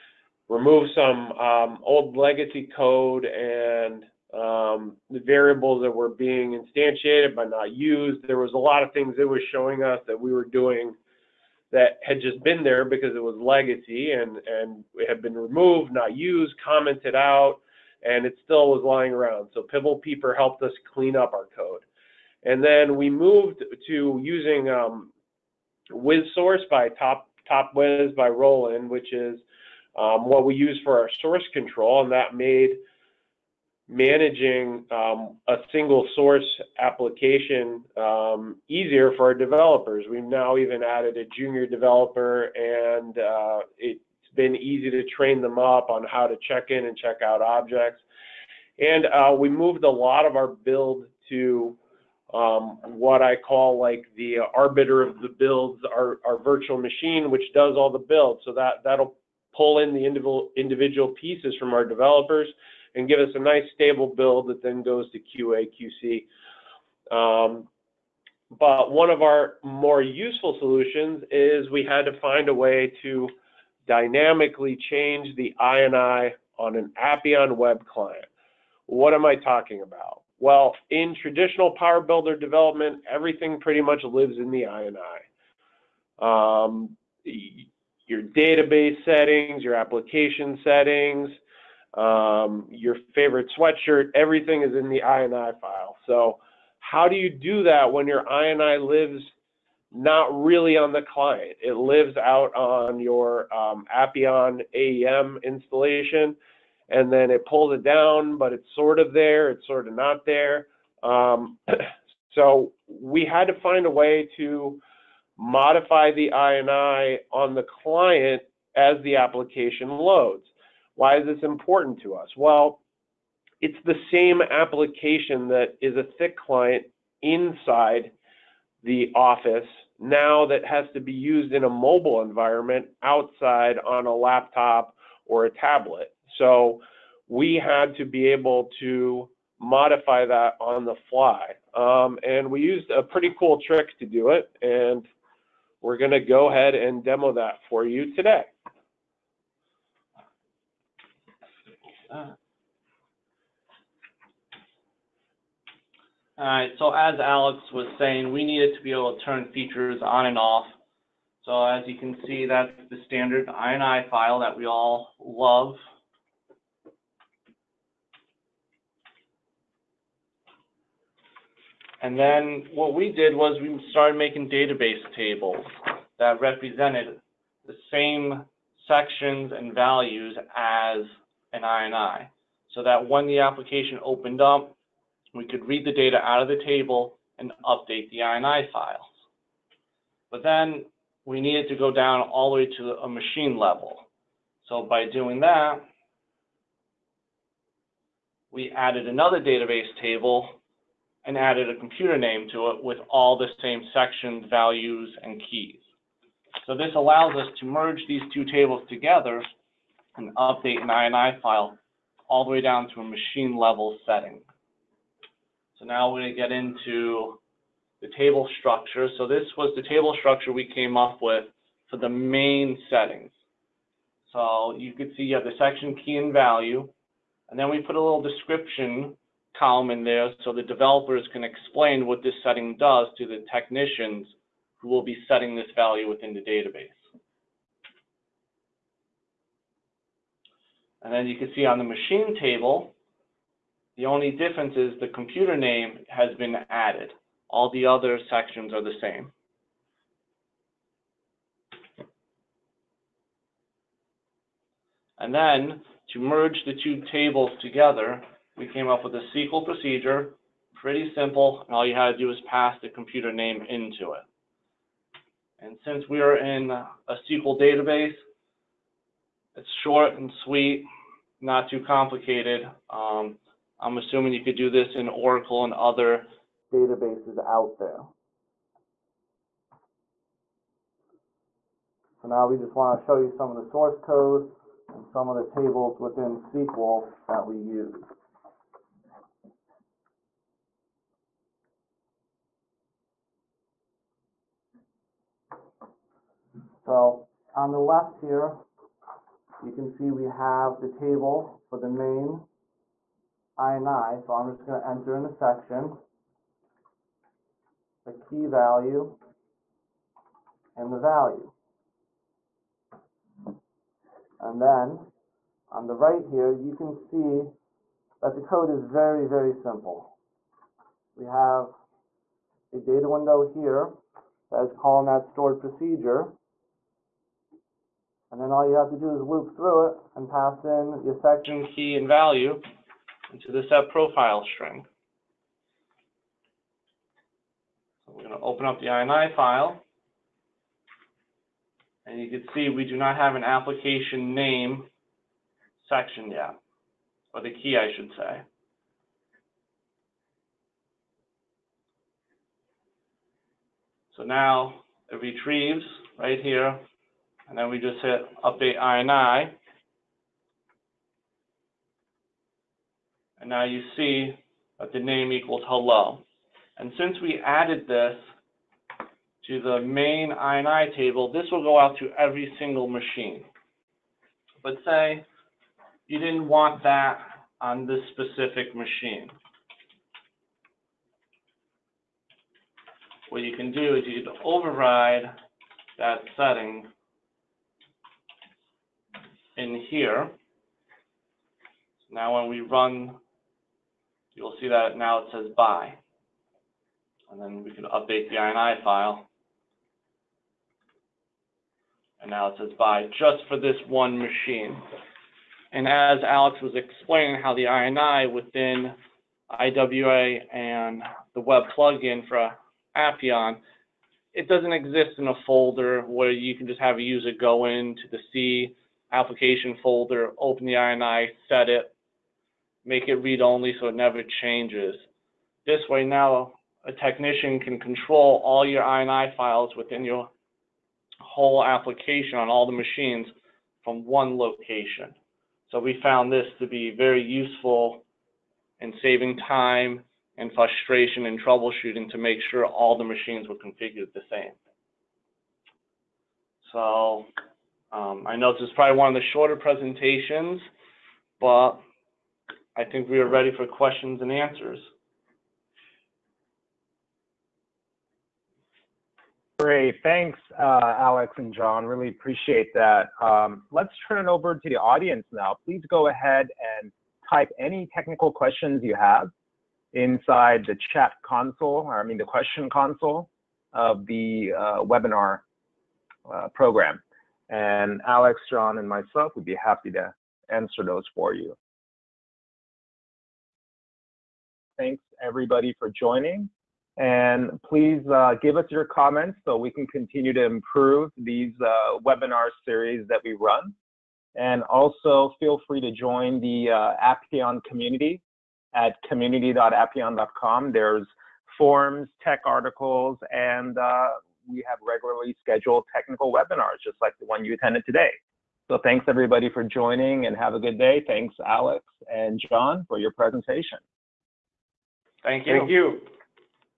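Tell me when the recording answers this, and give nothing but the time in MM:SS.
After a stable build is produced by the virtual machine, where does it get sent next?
01:05.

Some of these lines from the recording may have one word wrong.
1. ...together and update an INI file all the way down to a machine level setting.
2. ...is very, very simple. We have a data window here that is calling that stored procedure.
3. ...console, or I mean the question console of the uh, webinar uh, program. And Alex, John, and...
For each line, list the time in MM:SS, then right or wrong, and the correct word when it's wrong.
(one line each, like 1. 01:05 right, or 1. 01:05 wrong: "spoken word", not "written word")
1. 03:28 right
2. 05:18 right
3. 07:51 right.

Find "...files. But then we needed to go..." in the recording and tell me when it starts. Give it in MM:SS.
03:08.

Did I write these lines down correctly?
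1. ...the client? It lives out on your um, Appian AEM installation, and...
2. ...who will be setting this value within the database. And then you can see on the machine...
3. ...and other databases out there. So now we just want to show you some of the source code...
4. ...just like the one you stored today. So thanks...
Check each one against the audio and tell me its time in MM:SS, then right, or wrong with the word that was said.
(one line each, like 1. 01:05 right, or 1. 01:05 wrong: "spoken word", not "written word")
1. 01:40 right
2. 03:54 right
3. 04:35 right
4. 08:26 wrong: "attended", not "stored".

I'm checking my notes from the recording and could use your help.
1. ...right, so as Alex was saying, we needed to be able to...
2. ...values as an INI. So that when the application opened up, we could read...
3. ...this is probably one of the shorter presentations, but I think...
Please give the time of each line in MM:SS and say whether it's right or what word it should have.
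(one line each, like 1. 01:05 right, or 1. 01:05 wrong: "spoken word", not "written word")
1. 02:36 right
2. 02:59 right
3. 07:28 right.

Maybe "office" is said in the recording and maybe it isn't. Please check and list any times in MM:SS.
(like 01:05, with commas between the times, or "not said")
02:09.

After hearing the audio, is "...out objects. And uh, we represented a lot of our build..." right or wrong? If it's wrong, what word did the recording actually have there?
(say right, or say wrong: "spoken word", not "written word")
wrong: "moved", not "represented".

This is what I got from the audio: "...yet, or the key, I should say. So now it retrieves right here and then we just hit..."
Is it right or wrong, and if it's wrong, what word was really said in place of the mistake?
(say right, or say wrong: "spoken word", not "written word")
right.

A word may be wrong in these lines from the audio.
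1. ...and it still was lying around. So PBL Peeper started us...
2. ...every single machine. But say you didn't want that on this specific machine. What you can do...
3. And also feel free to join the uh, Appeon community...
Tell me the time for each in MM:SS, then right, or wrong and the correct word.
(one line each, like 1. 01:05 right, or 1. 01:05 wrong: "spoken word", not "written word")
1. 00:18 wrong: "helped", not "started"
2. 06:12 right
3. 08:14 right.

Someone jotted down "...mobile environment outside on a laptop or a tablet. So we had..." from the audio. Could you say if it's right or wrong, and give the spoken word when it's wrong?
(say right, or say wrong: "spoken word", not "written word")
right.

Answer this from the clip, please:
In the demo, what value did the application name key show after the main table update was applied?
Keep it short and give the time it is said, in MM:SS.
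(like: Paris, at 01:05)
hello, at 06:05.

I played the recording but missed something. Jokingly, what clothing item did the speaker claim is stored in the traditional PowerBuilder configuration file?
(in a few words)
favorite sweatshirt.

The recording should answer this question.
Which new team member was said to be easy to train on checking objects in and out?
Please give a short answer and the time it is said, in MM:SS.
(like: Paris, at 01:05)
junior developer, at 00:41.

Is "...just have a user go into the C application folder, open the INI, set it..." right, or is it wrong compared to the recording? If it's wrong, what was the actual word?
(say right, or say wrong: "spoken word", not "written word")
right.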